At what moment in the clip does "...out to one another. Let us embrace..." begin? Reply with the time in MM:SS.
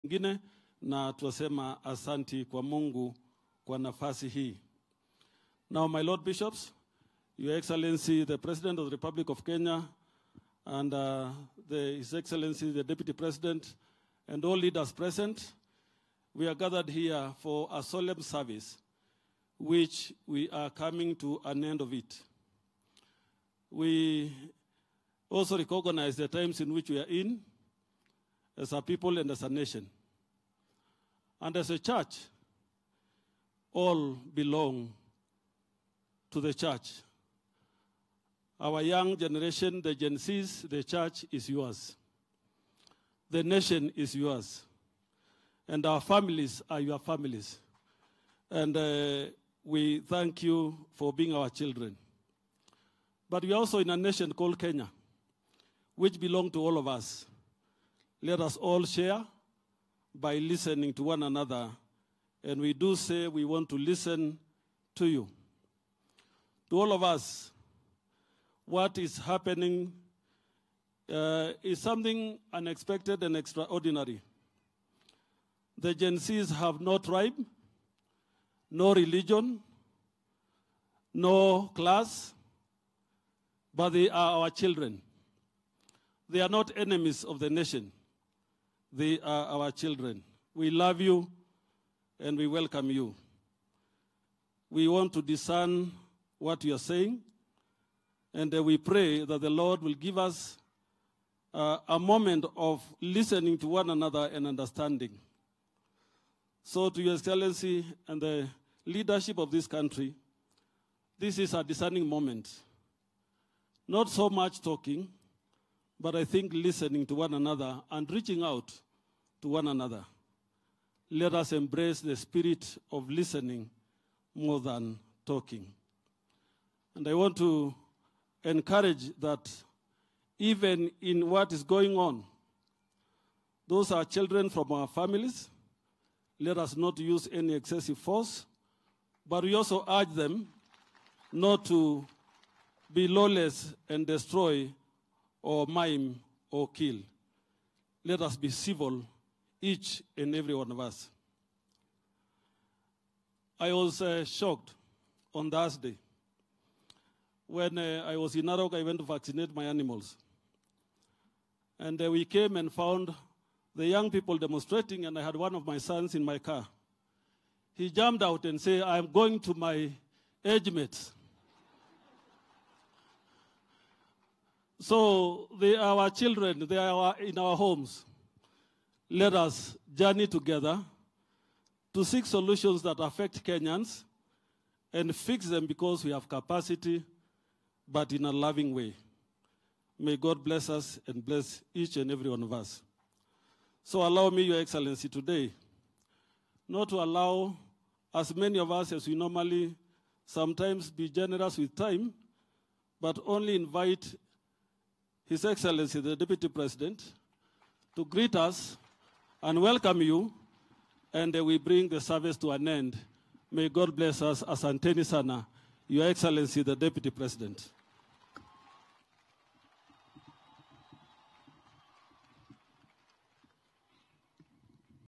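01:58.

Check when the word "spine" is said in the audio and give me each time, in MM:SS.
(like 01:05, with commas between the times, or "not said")
not said.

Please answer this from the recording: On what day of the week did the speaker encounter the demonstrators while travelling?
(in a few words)
Thursday.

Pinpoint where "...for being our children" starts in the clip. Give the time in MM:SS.
00:50.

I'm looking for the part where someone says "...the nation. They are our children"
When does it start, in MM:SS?
01:27.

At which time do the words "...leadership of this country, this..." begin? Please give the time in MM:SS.
01:48.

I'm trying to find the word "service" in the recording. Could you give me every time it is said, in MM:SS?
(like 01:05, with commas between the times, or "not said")
00:18, 03:32.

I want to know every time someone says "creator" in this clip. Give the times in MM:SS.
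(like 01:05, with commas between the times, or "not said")
not said.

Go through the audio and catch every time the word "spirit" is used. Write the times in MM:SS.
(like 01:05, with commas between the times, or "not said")
02:02.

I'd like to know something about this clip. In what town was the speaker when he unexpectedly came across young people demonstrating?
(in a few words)
Narok.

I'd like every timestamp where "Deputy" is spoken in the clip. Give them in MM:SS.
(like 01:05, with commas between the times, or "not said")
00:12, 03:26, 03:36.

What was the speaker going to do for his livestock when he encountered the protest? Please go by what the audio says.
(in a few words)
Vaccinate.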